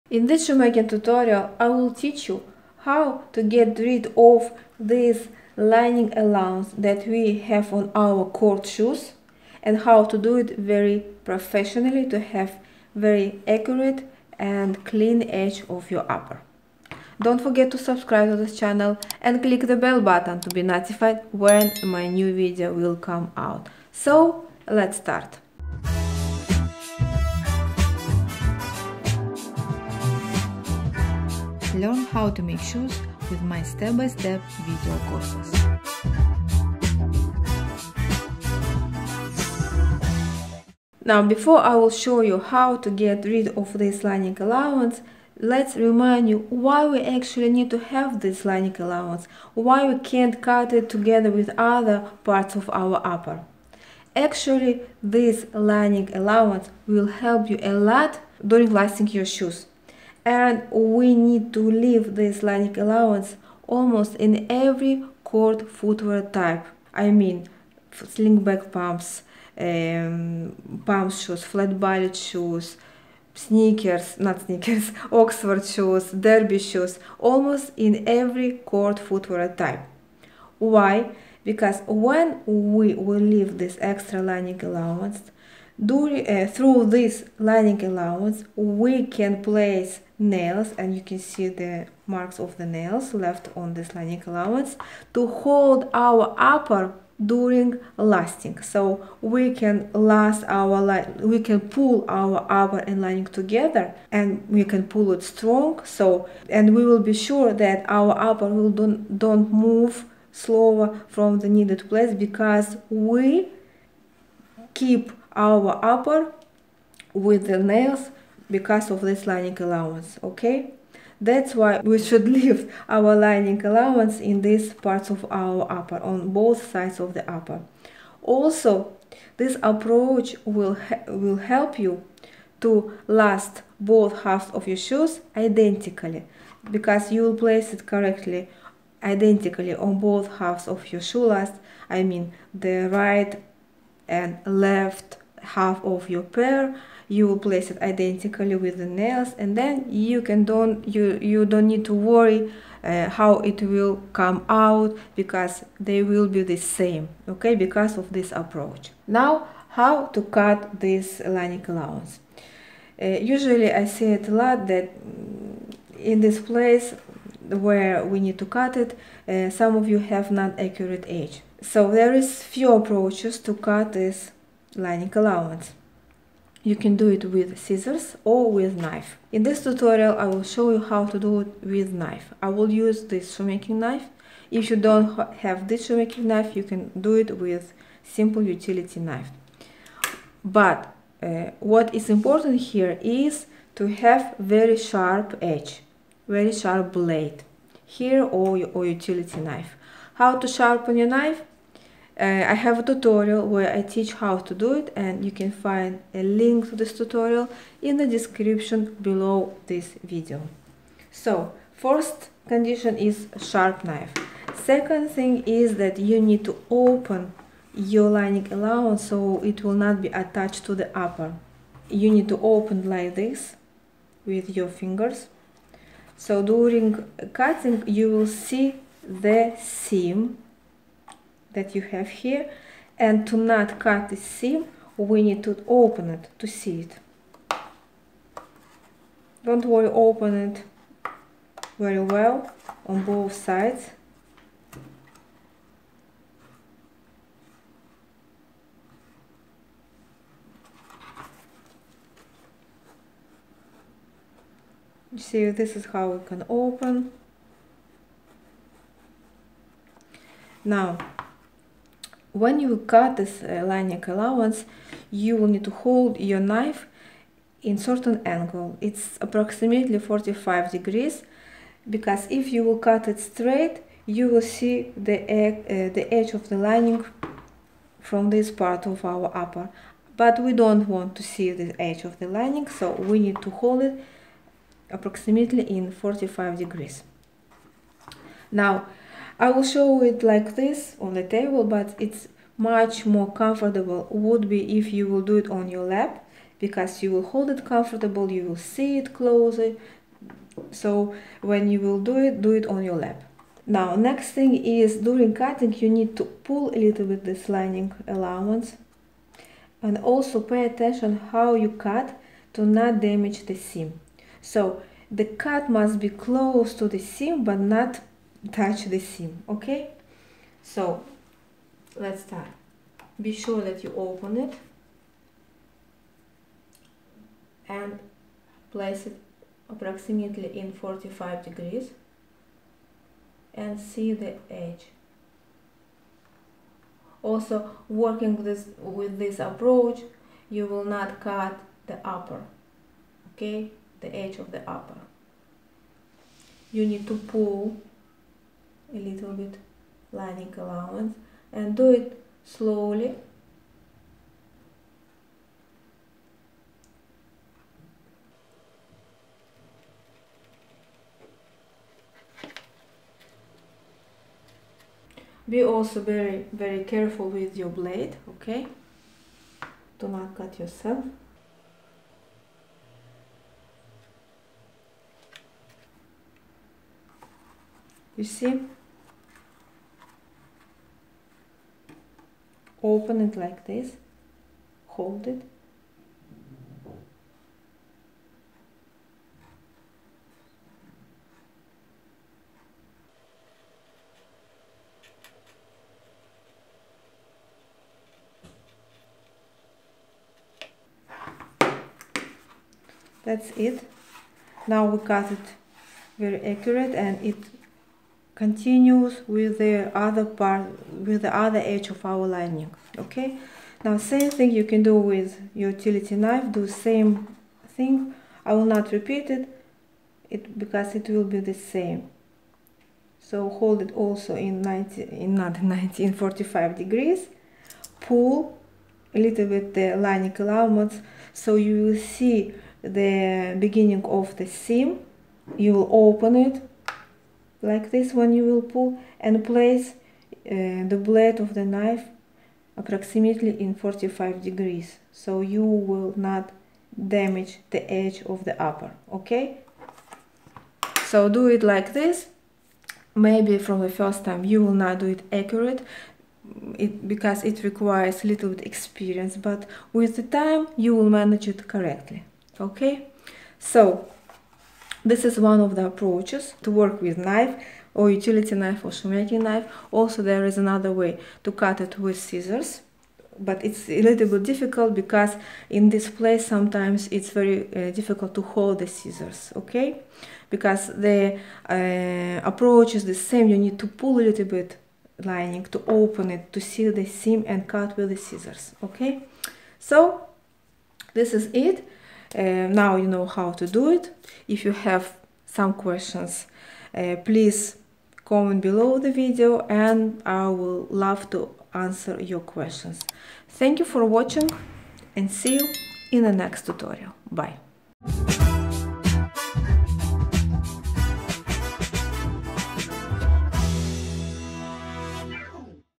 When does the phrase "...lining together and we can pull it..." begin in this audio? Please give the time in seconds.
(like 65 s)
103 s.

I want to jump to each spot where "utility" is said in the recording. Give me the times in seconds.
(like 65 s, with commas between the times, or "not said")
188 s, 198 s, 415 s, 468 s.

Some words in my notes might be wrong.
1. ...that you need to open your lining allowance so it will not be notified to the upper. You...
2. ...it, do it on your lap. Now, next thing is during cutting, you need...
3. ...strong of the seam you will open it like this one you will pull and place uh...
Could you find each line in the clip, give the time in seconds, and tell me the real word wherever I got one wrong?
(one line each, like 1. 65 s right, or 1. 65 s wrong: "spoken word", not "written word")
1. 215 s wrong: "attached", not "notified"
2. 302 s right
3. 433 s wrong: "beginning", not "strong".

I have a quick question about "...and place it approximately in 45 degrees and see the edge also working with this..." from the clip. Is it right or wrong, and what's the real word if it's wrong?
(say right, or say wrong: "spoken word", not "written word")
right.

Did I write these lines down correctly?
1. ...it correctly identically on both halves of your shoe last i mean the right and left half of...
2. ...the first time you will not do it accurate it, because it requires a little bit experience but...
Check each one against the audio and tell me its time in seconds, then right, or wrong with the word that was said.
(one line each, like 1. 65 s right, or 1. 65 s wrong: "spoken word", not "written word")
1. 137 s right
2. 453 s right.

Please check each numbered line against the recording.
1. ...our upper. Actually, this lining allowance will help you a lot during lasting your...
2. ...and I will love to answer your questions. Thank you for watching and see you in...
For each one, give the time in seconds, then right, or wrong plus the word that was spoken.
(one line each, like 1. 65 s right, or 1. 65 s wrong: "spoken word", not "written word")
1. 52 s right
2. 499 s right.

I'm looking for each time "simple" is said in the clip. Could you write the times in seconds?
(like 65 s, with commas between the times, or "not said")
188 s.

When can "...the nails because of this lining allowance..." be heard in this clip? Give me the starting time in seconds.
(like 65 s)
117 s.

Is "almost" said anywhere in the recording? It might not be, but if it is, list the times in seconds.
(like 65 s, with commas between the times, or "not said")
63 s, 77 s.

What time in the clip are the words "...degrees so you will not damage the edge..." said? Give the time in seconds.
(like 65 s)
444 s.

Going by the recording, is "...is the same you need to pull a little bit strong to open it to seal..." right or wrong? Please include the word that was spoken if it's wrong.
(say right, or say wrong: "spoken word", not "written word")
wrong: "lining", not "strong".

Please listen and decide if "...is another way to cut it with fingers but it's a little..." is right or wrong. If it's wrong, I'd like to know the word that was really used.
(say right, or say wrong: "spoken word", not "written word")
wrong: "scissors", not "fingers".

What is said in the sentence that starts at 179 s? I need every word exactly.
In this tutorial I will show you how to do it with knife.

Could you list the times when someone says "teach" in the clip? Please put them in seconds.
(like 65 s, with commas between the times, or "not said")
1 s, 203 s.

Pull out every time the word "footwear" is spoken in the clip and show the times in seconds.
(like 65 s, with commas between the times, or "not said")
65 s, 78 s.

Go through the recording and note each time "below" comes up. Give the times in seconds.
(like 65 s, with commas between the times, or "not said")
209 s, 498 s.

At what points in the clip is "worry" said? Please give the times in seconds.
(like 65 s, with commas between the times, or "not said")
151 s, 239 s.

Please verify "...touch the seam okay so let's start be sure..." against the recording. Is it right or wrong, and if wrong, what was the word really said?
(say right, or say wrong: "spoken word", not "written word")
right.